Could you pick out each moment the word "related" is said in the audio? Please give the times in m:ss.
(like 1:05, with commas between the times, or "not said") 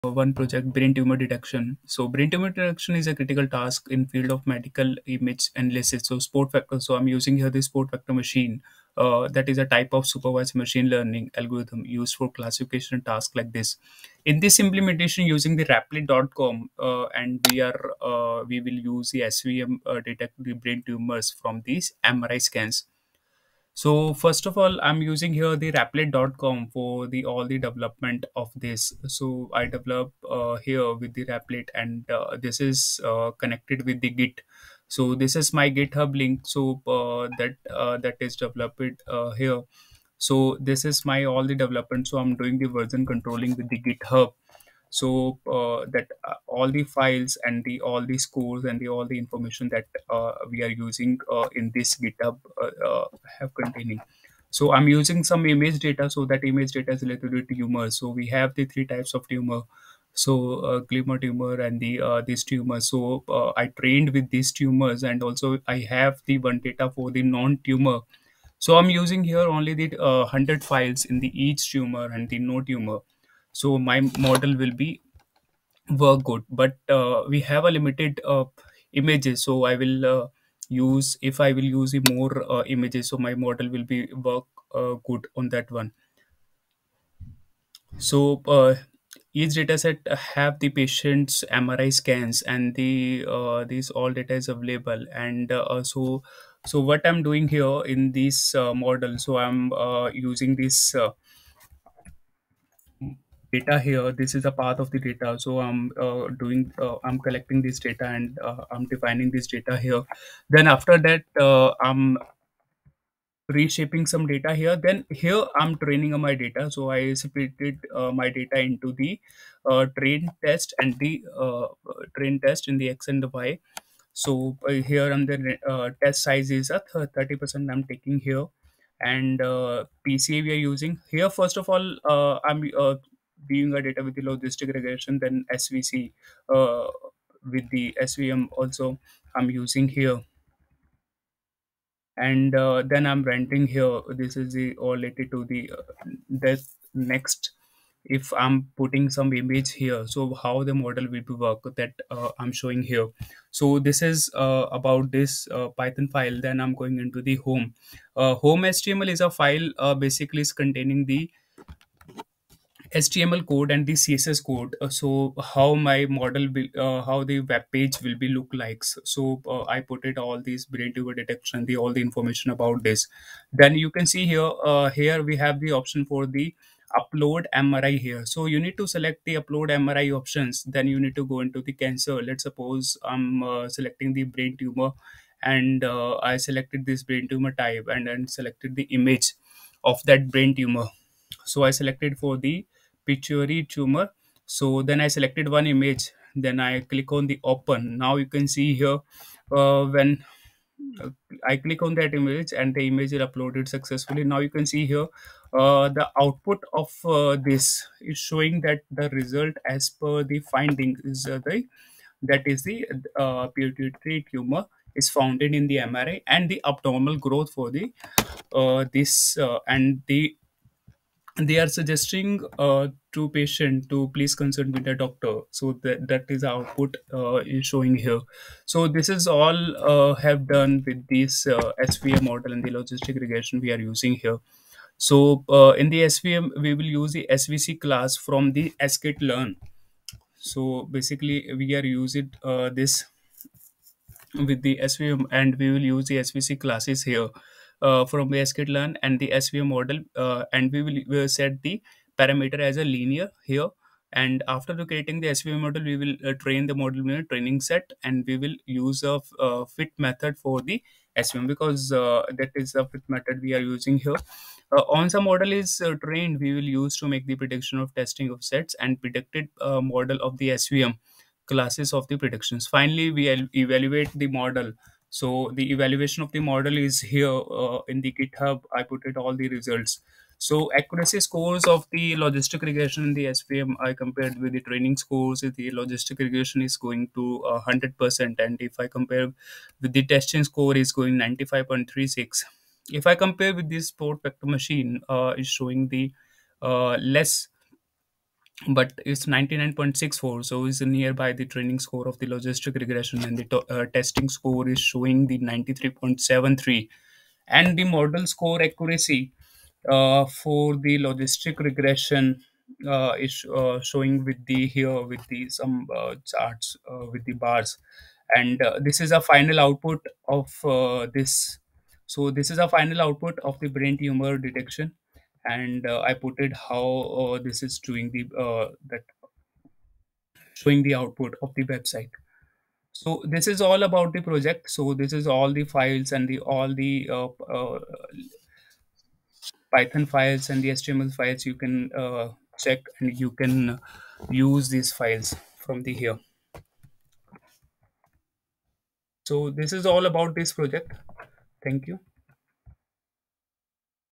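0:57, 2:24.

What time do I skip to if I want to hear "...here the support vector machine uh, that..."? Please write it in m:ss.
0:07.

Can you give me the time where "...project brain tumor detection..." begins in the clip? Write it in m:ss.
0:00.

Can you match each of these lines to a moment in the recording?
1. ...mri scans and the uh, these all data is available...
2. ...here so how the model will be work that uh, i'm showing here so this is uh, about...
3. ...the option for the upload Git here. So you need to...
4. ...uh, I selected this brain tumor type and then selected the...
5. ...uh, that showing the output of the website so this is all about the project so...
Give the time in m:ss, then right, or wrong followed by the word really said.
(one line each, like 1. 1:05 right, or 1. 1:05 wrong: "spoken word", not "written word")
1. 1:31 right
2. 2:29 right
3. 2:55 wrong: "MRI", not "Git"
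4. 3:05 right
5. 5:28 right.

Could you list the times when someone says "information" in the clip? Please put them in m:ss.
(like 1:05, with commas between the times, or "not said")
0:49, 2:52.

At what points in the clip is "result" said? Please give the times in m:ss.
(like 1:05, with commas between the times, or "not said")
3:29, 4:39.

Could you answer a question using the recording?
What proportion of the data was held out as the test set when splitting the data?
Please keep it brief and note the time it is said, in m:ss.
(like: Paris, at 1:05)
30 percent, at 2:07.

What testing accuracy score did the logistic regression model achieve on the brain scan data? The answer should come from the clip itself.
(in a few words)
95.36.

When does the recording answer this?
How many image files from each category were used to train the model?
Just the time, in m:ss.
1:10.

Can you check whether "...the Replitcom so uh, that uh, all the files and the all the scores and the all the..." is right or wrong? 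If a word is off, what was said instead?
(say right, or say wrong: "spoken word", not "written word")
wrong: "GitHub", not "Replitcom".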